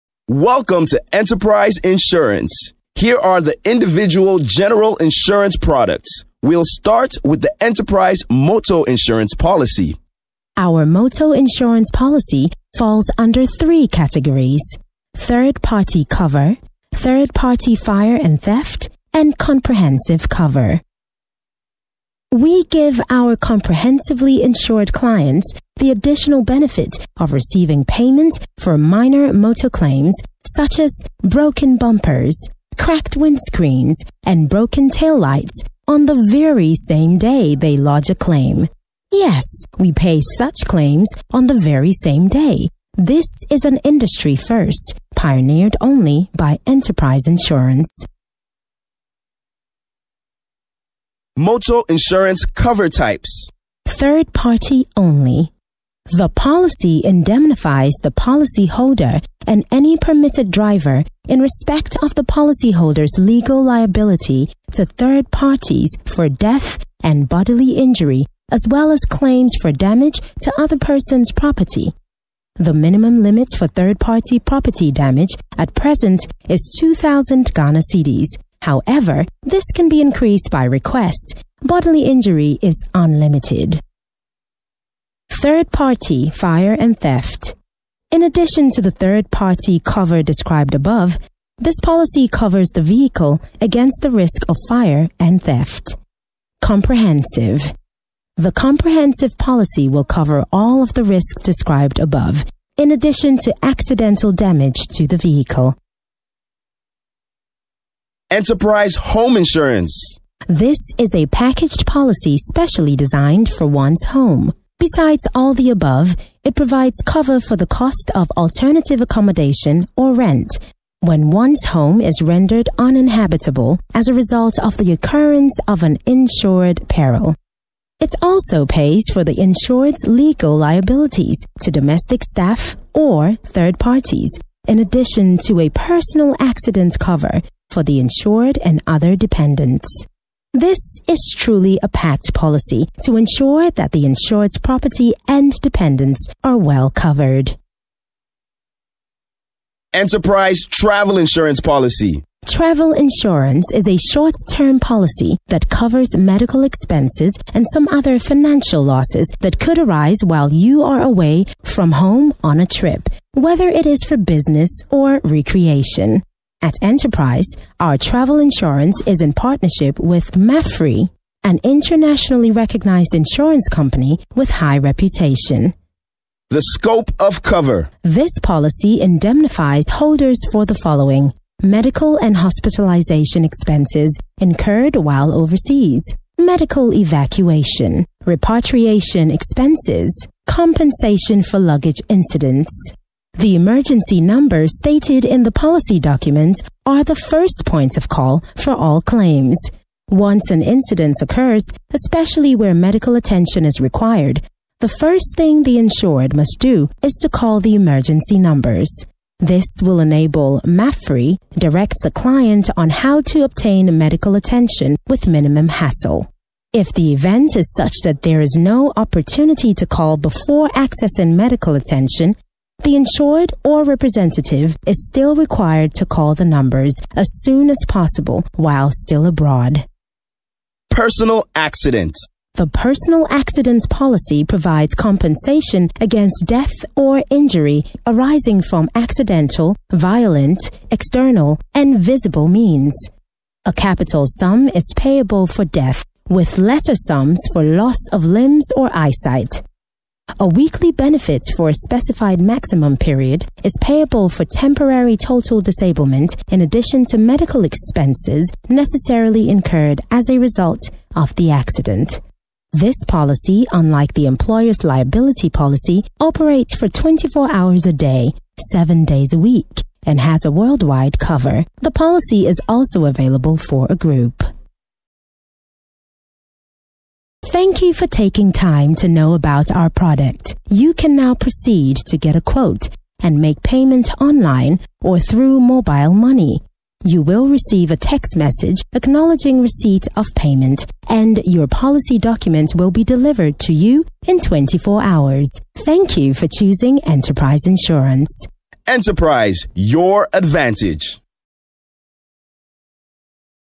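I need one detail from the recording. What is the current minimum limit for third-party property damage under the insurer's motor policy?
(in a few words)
2,000 Ghana cedis.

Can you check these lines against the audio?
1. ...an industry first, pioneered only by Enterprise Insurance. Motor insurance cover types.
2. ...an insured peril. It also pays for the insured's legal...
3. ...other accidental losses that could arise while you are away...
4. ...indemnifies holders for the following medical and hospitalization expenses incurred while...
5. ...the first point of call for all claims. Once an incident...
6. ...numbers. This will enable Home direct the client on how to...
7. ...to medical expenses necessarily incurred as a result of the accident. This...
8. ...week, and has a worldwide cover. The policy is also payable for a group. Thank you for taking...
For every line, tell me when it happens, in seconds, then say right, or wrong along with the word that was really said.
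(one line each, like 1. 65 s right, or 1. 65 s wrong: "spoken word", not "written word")
1. 43 s right
2. 125 s right
3. 157 s wrong: "financial", not "accidental"
4. 179 s right
5. 197 s right
6. 208 s wrong: "MAPFRE", not "Home"
7. 257 s right
8. 269 s wrong: "available", not "payable".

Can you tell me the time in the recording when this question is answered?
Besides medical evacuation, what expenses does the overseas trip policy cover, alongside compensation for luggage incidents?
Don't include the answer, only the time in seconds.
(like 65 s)
188 s.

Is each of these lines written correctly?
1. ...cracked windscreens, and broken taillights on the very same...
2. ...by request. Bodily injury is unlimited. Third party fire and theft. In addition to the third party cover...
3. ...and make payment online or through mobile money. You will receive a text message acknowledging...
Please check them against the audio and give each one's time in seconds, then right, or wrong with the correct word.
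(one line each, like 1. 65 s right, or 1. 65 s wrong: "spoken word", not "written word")
1. 32 s right
2. 80 s right
3. 283 s right.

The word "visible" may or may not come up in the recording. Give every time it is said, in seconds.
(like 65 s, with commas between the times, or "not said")
241 s.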